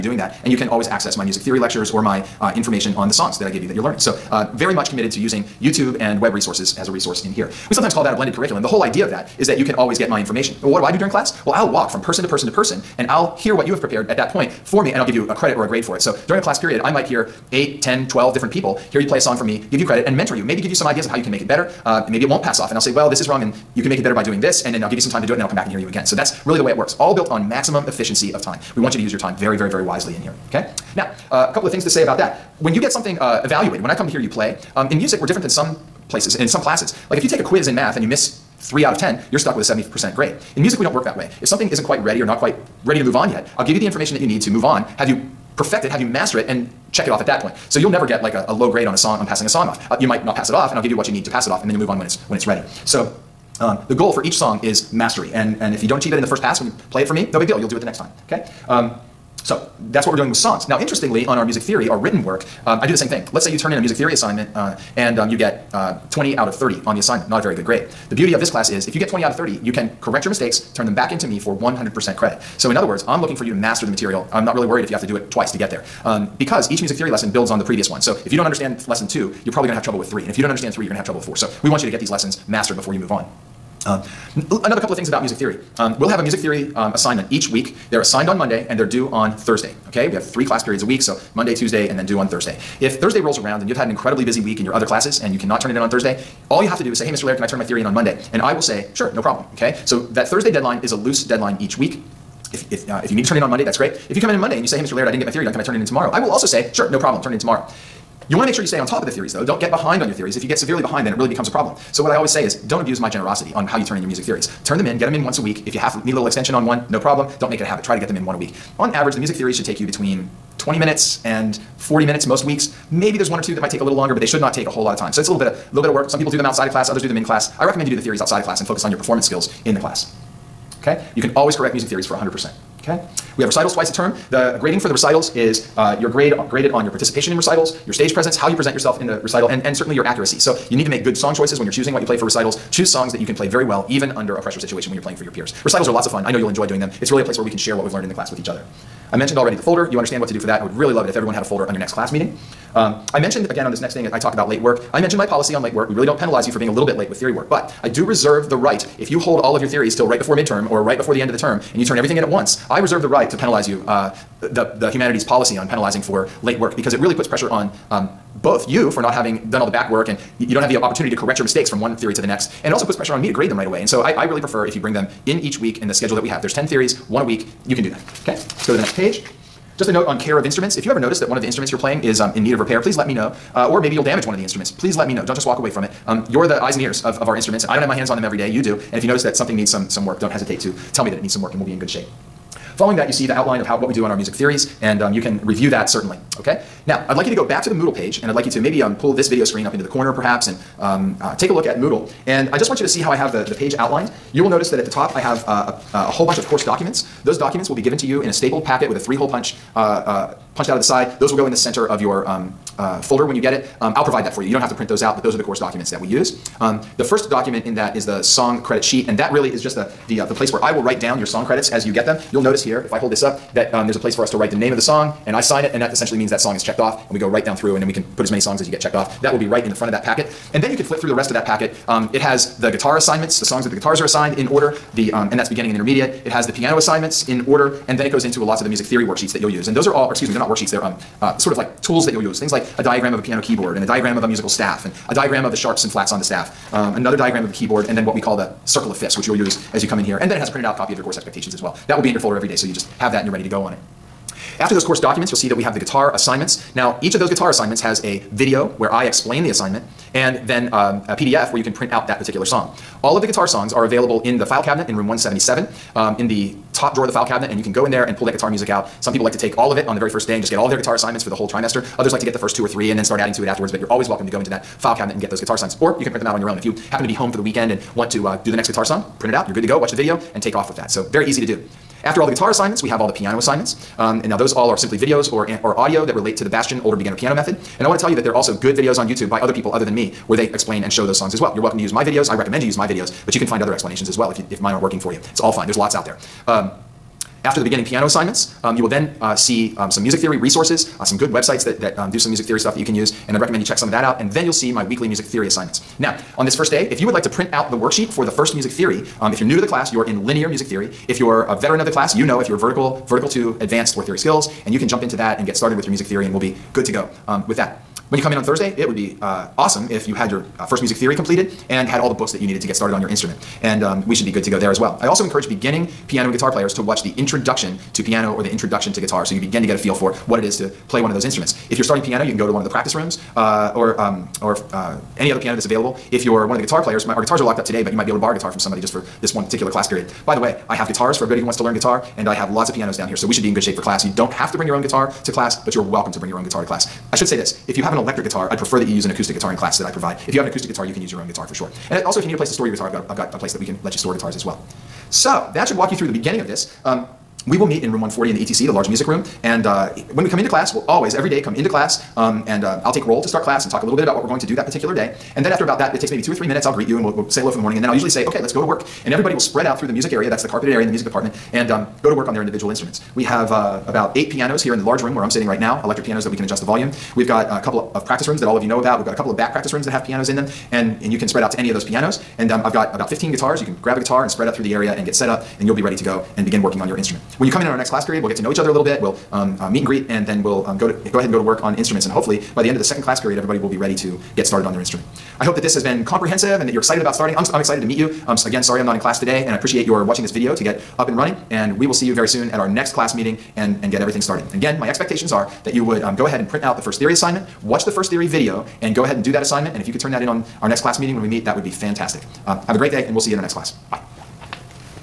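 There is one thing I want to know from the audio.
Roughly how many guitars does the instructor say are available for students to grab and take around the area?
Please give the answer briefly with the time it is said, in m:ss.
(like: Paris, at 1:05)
15, at 6:22.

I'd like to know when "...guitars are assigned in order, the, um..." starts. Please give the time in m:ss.
3:53.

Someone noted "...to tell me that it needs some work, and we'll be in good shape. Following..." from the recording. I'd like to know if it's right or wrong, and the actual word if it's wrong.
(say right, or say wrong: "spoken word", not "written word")
right.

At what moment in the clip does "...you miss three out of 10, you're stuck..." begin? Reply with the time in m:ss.
0:38.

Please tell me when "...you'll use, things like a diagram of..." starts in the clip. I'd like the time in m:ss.
4:02.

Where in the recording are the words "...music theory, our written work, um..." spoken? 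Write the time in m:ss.
1:01.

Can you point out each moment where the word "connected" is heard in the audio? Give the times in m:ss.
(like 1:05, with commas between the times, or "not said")
not said.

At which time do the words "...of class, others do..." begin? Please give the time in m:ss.
2:06.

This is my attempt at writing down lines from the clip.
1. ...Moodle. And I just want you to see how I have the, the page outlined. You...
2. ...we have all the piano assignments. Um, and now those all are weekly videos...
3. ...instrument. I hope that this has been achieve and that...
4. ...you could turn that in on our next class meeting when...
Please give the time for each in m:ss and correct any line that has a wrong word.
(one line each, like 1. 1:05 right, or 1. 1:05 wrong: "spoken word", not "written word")
1. 3:21 right
2. 4:42 wrong: "simply", not "weekly"
3. 6:34 wrong: "comprehensive", not "achieve"
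4. 6:49 right.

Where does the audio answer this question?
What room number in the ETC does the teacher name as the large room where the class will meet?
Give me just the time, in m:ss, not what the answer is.
5:57.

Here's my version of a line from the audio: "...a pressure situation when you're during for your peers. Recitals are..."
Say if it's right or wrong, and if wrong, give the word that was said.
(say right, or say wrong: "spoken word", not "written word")
wrong: "playing", not "during".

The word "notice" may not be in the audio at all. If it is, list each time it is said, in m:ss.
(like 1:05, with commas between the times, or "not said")
3:00, 3:09, 3:24, 3:42.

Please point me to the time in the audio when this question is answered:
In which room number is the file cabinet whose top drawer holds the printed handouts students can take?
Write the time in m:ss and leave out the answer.
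4:24.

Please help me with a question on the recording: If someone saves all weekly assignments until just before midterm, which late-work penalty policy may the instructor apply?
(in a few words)
The humanities policy.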